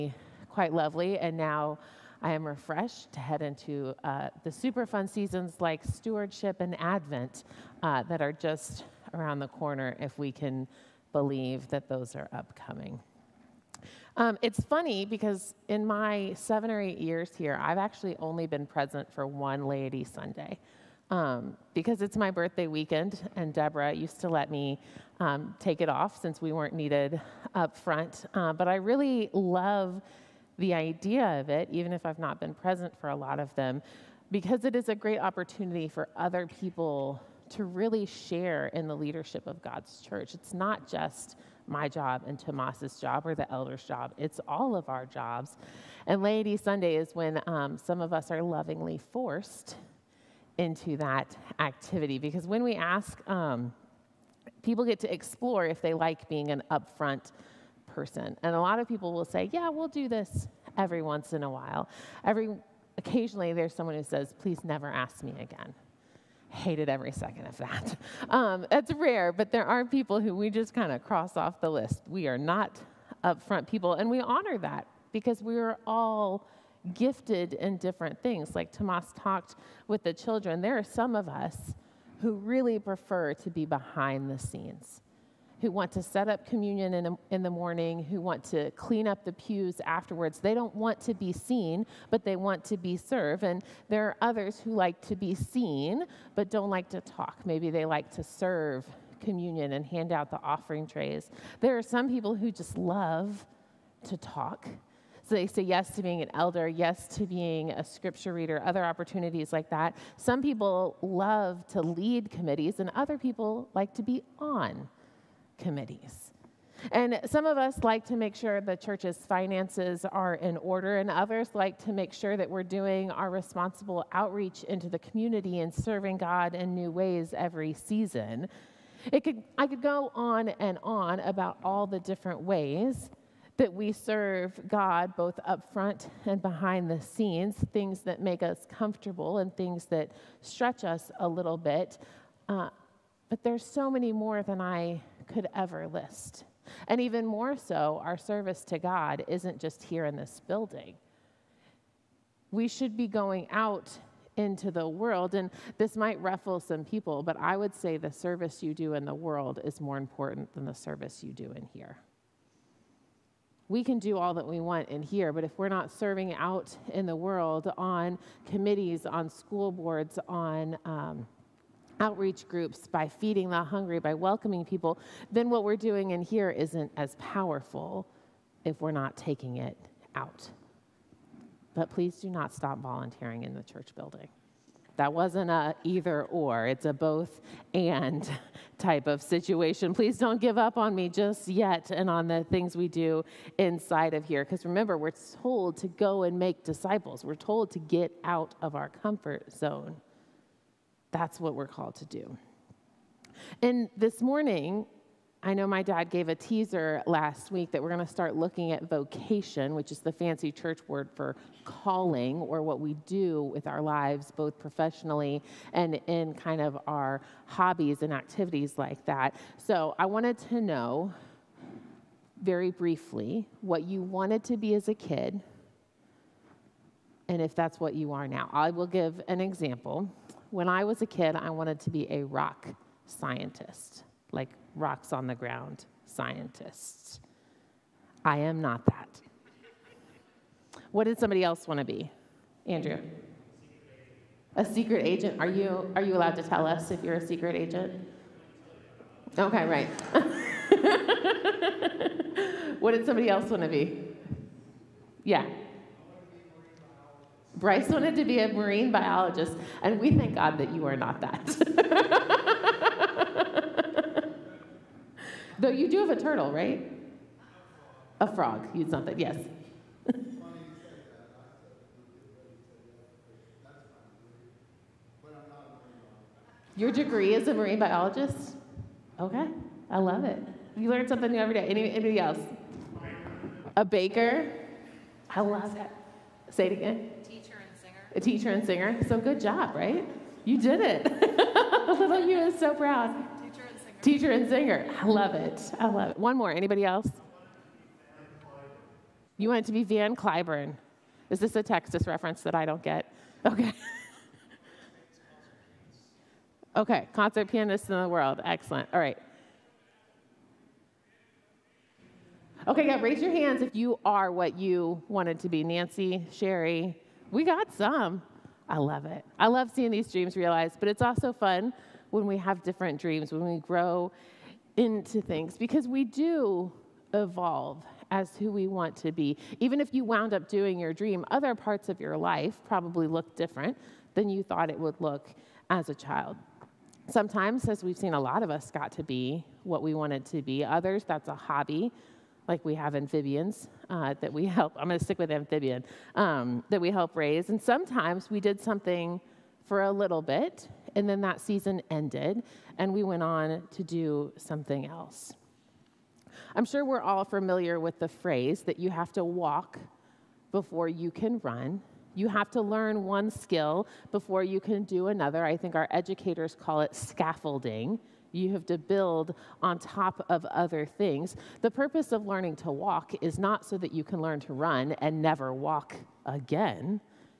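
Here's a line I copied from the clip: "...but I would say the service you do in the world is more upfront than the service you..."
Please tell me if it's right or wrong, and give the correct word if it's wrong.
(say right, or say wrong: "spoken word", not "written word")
wrong: "important", not "upfront".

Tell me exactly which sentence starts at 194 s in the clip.
Because remember, we're told to go and make disciples, we're told to get out of our comfort zone.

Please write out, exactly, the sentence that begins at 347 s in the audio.
And sometimes we did something for a little bit, and then that season ended, and we went on to do something else.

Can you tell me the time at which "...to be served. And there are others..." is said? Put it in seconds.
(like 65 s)
92 s.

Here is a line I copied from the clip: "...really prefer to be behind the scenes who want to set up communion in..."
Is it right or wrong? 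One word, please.
right.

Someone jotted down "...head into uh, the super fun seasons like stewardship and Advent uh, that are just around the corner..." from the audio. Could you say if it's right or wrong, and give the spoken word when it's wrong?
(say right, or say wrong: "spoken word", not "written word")
right.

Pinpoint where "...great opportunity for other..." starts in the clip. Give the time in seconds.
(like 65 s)
34 s.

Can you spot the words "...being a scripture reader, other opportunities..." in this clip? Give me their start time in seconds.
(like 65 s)
107 s.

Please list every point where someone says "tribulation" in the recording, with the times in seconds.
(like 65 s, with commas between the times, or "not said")
not said.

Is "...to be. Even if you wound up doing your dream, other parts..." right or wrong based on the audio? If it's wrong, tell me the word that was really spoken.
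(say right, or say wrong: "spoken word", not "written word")
right.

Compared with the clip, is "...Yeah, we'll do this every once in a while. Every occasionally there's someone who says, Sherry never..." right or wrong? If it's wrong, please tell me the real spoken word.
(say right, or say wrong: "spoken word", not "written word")
wrong: "Please", not "Sherry".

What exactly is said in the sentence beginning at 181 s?
But please do not stop volunteering in the church building.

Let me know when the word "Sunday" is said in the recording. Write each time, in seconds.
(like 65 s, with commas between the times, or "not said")
20 s, 46 s.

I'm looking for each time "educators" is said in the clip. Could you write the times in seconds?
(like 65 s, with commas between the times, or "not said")
365 s.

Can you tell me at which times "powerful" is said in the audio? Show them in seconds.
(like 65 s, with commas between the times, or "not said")
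177 s.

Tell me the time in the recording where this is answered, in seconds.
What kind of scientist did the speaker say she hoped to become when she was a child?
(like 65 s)
232 s.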